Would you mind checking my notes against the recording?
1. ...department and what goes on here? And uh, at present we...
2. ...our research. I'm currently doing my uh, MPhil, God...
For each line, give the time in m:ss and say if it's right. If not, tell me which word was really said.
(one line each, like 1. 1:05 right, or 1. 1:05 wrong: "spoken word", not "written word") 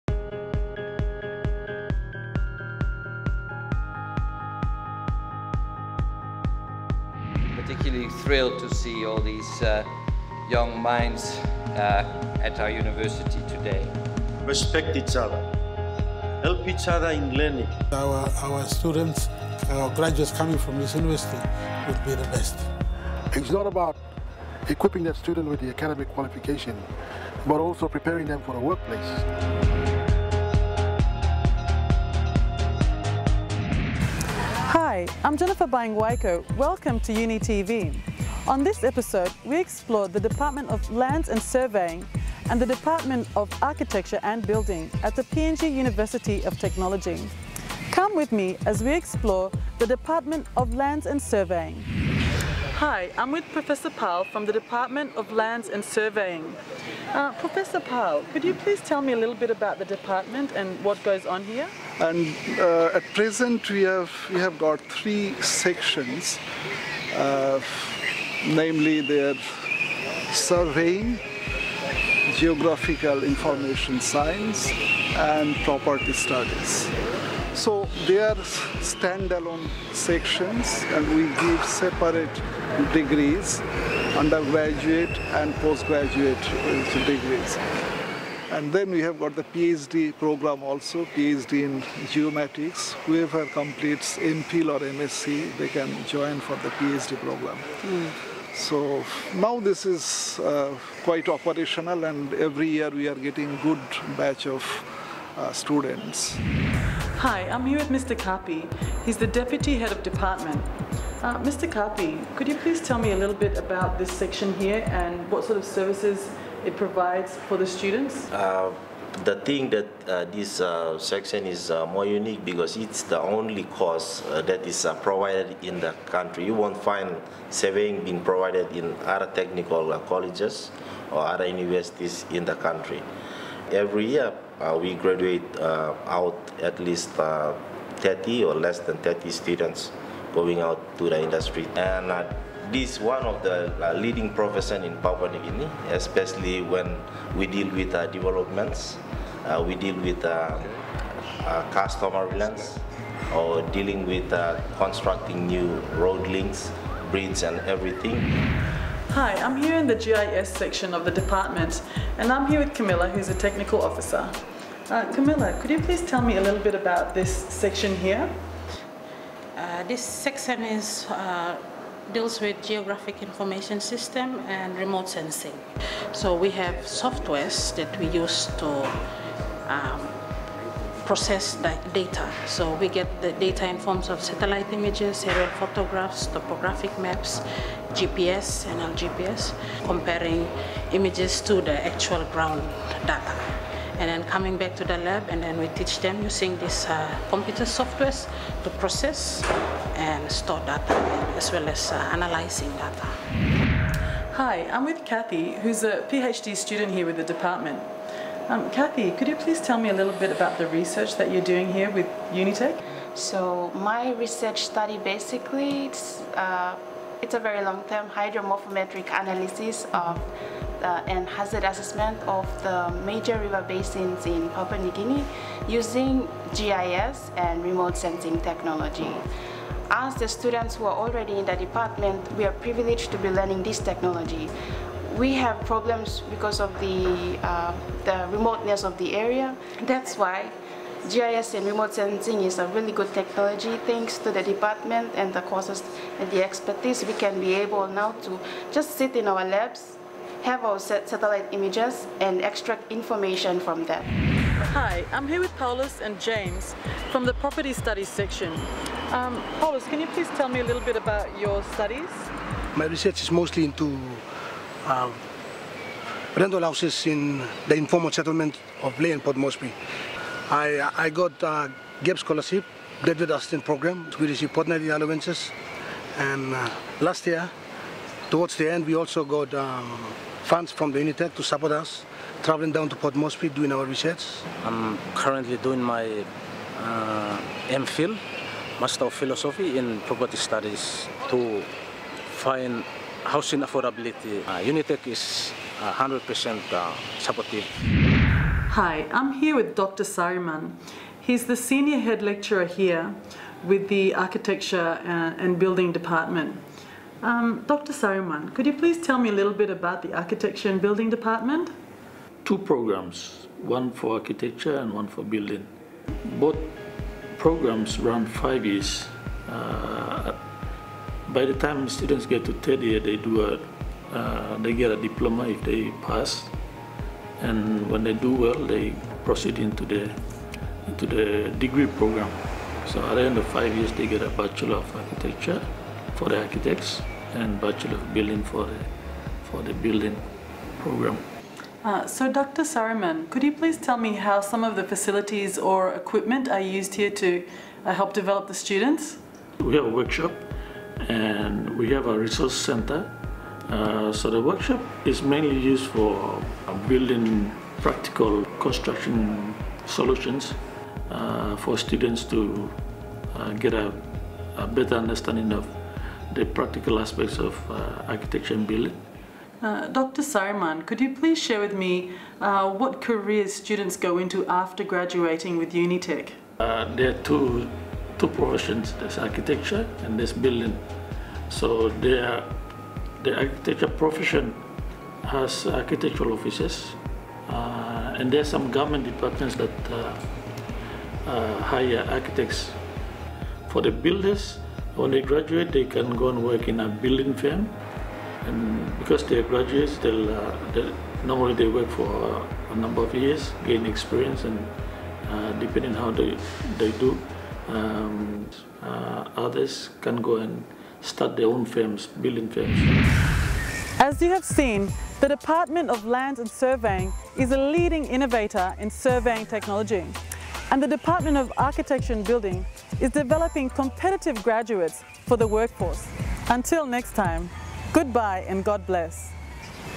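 1. 0:59 right
2. 4:43 wrong: "Master", not "God".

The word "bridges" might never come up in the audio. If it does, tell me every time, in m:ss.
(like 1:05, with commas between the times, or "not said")
2:37.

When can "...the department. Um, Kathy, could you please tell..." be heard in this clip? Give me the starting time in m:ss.
3:27.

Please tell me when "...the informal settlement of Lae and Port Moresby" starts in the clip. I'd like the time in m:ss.
4:27.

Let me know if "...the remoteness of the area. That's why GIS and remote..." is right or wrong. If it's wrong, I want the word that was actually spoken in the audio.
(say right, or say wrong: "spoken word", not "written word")
right.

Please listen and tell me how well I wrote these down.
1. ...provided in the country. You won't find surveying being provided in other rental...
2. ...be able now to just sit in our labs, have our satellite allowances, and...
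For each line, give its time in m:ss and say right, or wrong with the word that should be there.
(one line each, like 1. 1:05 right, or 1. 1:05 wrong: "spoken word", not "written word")
1. 2:05 wrong: "technical", not "rental"
2. 4:07 wrong: "images", not "allowances".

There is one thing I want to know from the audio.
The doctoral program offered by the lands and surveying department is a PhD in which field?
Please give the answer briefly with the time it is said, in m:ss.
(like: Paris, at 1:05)
Geomatics, at 1:32.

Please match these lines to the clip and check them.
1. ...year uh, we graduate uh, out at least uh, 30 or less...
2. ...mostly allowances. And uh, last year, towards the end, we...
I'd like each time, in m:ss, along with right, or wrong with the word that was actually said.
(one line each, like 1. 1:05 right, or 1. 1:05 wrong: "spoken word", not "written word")
1. 2:14 right
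2. 4:34 wrong: "fortnightly", not "mostly".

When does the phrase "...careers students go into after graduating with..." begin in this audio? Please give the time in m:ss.
6:13.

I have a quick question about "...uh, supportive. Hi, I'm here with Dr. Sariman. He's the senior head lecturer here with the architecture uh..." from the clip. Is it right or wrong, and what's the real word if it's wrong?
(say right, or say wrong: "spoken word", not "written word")
right.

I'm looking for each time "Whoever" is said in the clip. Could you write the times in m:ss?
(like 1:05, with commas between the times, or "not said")
1:33.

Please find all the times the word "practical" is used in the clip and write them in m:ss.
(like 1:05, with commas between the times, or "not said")
5:57, 6:06.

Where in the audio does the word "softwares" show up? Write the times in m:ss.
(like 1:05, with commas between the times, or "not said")
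2:56, 3:17.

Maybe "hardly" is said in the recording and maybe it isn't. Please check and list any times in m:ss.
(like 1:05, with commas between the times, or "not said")
not said.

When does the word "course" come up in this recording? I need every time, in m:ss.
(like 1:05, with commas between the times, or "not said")
2:03, 4:05.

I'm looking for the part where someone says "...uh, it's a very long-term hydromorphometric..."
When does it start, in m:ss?
3:36.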